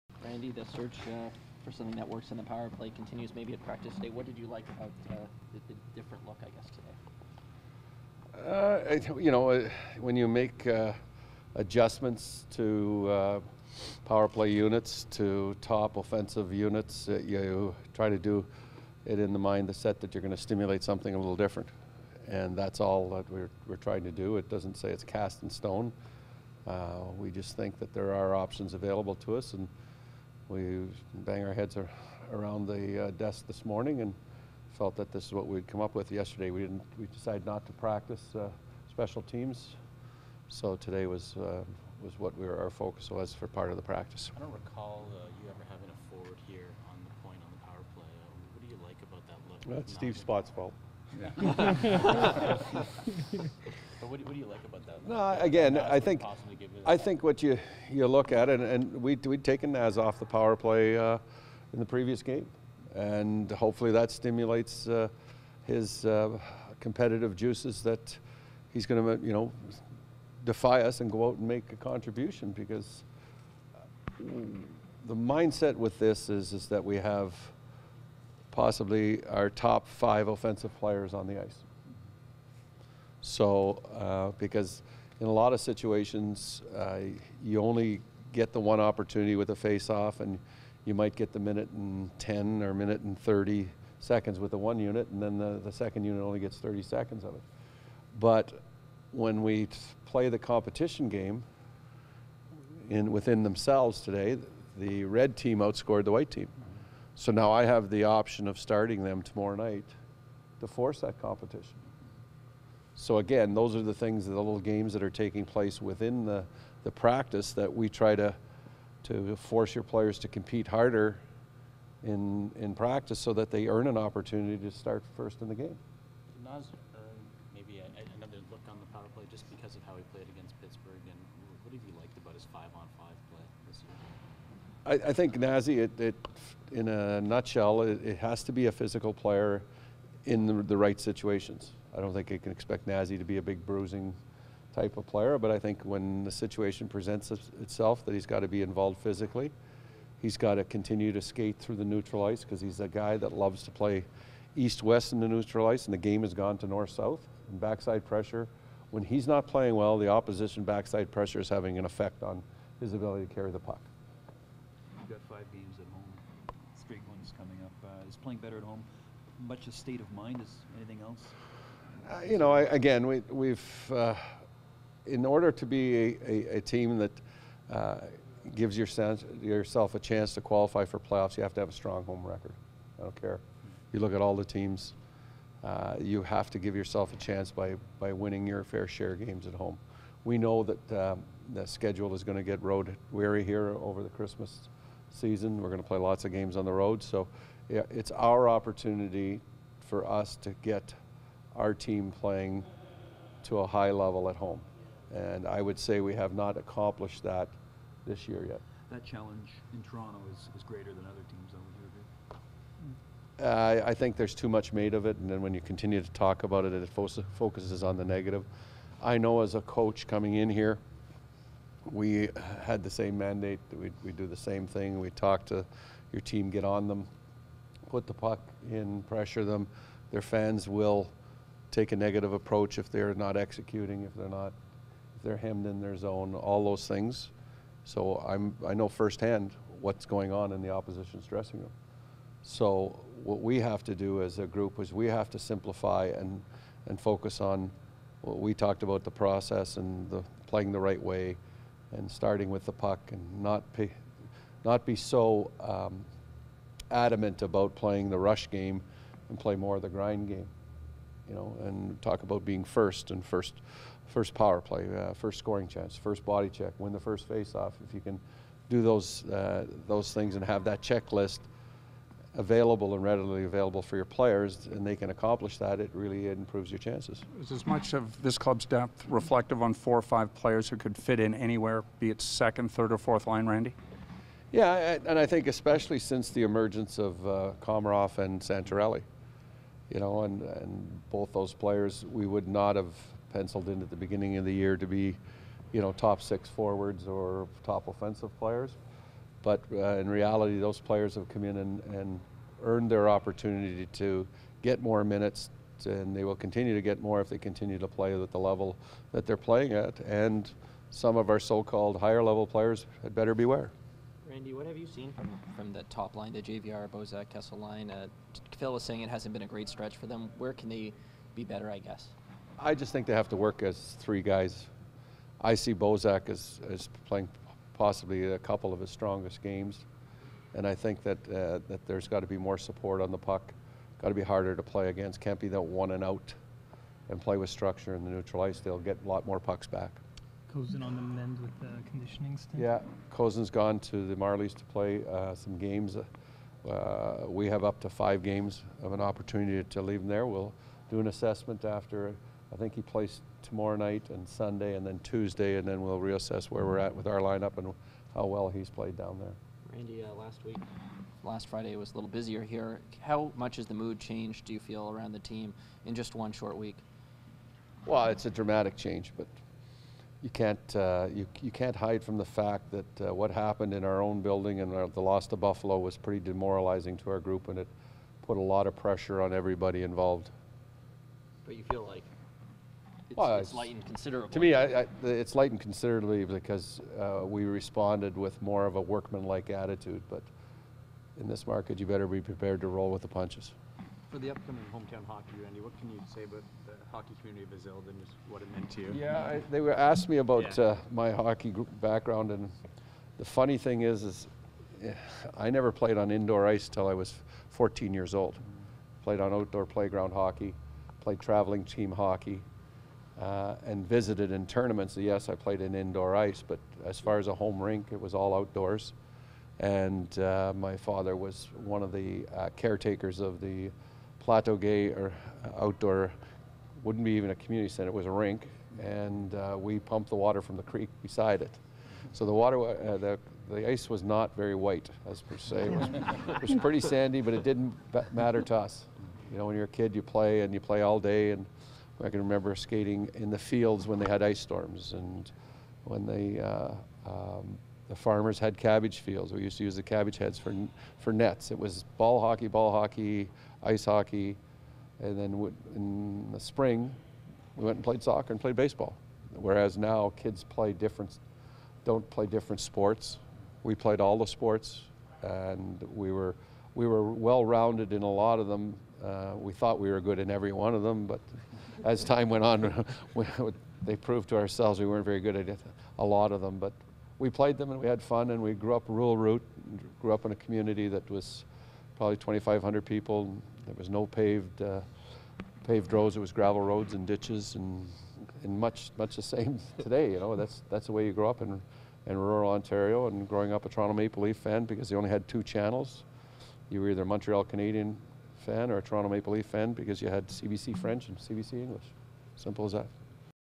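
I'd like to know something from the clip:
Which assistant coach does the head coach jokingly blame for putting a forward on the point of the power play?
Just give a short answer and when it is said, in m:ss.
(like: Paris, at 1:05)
Steve Spott, at 0:49.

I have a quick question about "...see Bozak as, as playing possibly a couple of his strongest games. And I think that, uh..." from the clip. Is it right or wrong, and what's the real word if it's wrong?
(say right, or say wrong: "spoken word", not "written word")
right.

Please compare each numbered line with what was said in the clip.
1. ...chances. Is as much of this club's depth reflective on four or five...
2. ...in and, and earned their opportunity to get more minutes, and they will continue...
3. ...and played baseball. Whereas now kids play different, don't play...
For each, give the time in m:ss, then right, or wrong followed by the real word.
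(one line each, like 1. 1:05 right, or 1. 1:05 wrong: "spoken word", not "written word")
1. 4:36 right
2. 5:01 right
3. 7:38 right.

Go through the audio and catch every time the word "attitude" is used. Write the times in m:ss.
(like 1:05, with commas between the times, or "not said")
6:29.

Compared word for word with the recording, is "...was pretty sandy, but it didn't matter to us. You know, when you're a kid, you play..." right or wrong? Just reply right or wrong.
right.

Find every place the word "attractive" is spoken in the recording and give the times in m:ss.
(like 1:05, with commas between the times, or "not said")
not said.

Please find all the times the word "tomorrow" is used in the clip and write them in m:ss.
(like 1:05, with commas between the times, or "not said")
1:49, 5:53.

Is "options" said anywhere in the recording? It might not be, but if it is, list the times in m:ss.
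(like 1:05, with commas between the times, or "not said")
0:28, 1:48.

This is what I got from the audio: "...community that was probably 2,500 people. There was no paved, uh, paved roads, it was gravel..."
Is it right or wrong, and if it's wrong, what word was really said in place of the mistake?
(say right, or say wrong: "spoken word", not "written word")
right.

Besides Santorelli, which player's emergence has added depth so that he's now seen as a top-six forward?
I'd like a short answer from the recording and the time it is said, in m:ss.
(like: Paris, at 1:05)
Komarov, at 4:47.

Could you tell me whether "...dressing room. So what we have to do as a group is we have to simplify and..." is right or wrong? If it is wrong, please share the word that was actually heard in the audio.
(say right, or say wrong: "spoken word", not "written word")
right.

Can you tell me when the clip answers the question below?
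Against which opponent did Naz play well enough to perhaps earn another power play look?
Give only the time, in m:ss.
2:10.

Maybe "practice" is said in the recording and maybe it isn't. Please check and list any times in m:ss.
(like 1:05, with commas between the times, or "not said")
0:03, 0:37, 0:43, 1:56, 2:02.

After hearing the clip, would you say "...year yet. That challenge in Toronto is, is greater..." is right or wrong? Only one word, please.
right.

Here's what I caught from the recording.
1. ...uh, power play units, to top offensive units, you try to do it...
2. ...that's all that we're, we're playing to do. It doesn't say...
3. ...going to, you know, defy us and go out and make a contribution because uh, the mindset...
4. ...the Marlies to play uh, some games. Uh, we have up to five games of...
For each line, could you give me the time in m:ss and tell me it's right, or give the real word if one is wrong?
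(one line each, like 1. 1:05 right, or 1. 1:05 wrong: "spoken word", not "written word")
1. 0:13 right
2. 0:22 wrong: "trying", not "playing"
3. 1:08 right
4. 5:44 right.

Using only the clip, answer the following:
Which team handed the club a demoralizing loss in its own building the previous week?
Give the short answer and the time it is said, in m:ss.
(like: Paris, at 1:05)
Buffalo, at 6:15.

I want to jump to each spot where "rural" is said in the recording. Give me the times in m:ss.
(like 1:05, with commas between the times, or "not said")
7:58, 8:12.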